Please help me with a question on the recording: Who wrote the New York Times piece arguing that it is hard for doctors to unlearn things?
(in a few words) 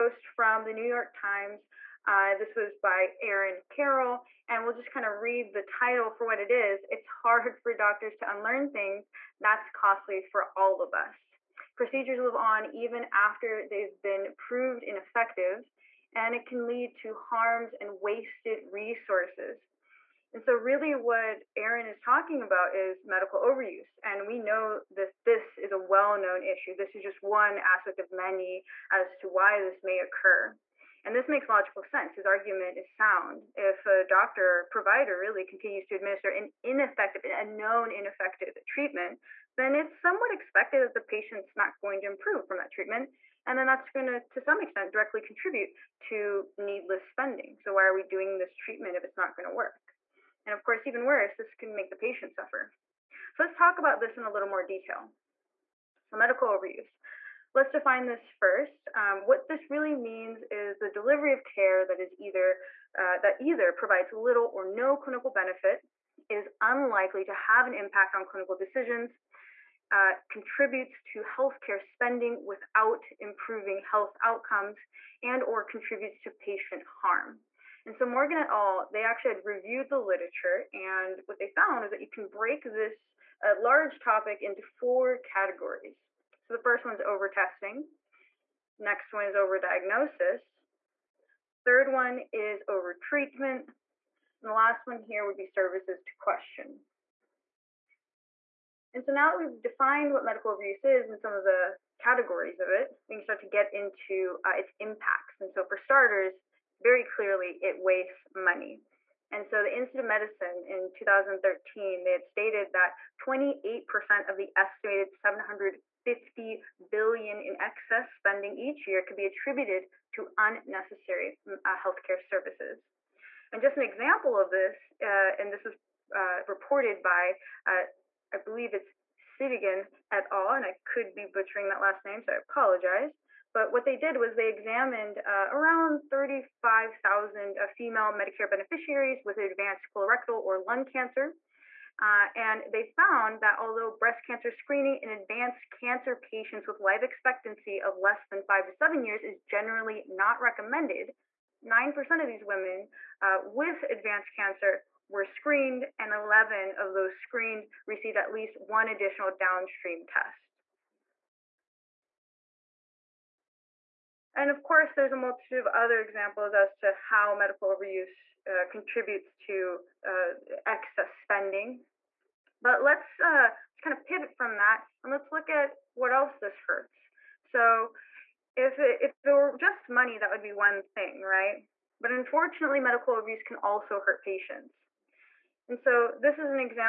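Aaron Carroll.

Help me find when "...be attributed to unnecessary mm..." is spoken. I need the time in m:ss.
1:59.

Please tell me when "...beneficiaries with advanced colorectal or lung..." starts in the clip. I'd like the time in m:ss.
2:18.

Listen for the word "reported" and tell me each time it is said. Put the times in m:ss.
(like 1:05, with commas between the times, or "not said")
2:06.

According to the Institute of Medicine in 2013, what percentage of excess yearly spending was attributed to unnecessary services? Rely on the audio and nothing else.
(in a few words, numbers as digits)
28%.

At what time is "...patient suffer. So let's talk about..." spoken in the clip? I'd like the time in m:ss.
0:51.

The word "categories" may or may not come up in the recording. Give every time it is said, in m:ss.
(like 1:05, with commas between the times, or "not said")
1:25, 1:41.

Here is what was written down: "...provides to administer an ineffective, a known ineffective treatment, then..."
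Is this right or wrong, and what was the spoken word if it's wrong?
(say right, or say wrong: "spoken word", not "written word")
wrong: "continues", not "provides".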